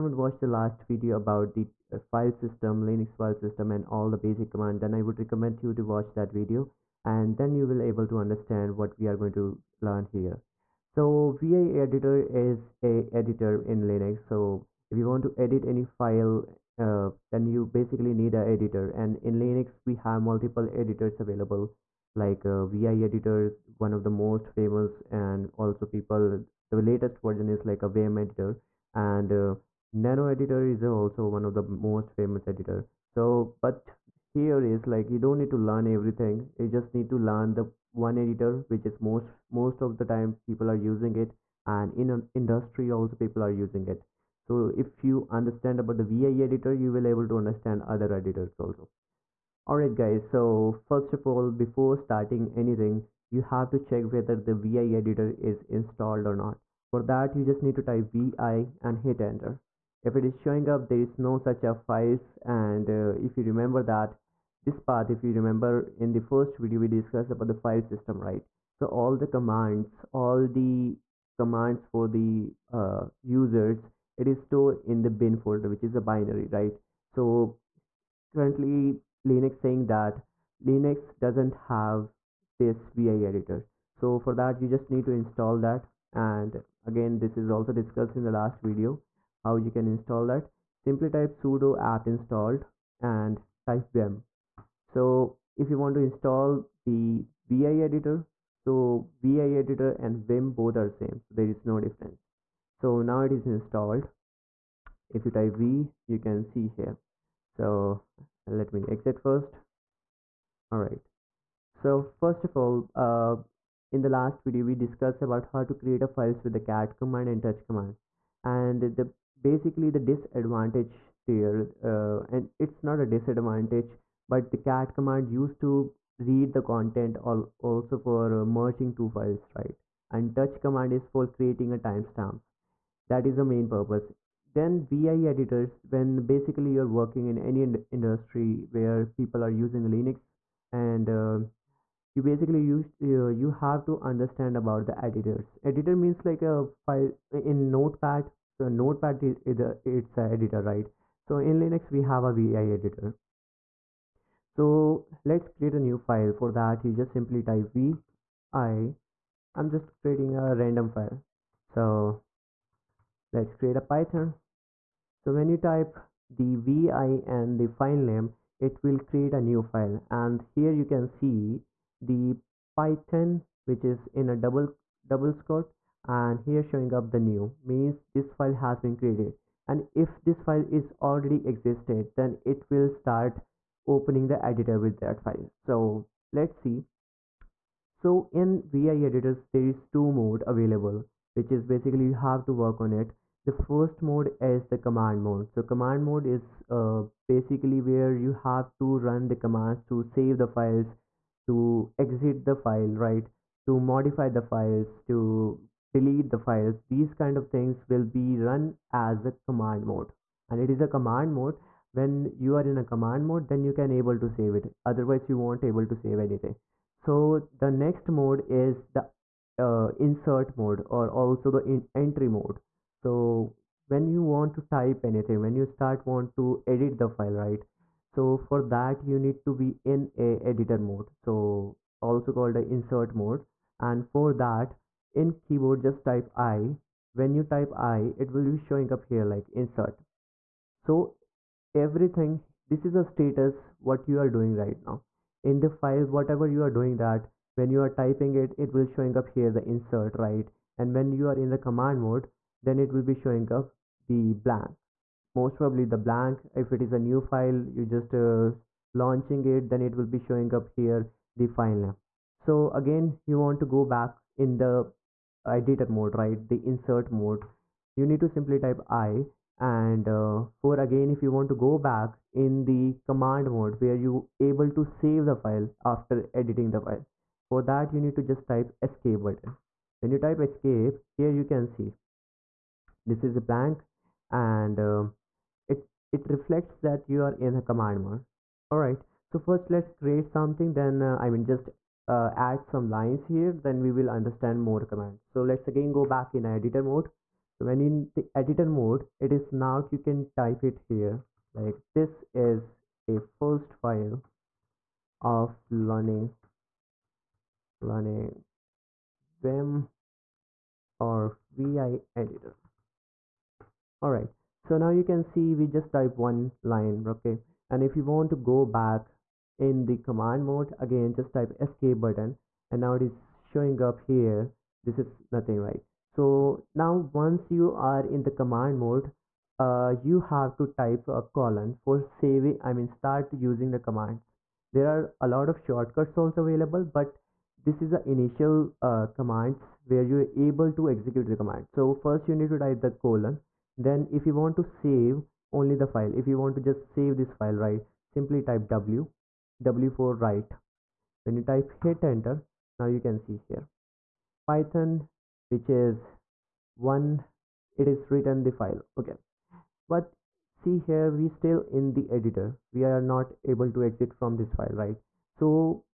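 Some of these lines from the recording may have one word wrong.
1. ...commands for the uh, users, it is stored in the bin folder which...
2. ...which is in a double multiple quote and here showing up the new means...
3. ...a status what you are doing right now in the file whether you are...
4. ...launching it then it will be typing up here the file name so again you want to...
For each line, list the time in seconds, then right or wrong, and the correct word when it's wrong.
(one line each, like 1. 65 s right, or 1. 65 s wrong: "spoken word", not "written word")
1. 71 s right
2. 173 s wrong: "double", not "multiple"
3. 242 s wrong: "whatever", not "whether"
4. 258 s wrong: "showing", not "typing".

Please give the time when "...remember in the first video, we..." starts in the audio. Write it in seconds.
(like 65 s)
65 s.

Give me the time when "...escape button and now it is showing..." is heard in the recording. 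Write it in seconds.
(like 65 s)
321 s.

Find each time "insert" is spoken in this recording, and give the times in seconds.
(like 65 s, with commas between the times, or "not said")
219 s, 232 s, 239 s, 249 s, 266 s.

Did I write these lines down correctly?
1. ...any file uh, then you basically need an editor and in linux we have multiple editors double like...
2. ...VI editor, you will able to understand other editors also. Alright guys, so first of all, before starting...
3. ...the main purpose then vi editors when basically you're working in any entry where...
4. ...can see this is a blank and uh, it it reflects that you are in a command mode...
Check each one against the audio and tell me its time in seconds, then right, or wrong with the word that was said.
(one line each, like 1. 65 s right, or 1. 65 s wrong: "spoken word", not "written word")
1. 15 s wrong: "available", not "double"
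2. 46 s right
3. 133 s wrong: "industry", not "entry"
4. 281 s right.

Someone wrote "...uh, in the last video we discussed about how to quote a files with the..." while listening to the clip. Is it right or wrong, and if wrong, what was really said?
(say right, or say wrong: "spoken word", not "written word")
wrong: "create", not "quote".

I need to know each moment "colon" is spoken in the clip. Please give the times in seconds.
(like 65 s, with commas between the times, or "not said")
331 s, 342 s.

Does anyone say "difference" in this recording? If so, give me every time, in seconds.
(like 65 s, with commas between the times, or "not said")
101 s.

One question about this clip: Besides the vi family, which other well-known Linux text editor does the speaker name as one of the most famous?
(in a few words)
nano.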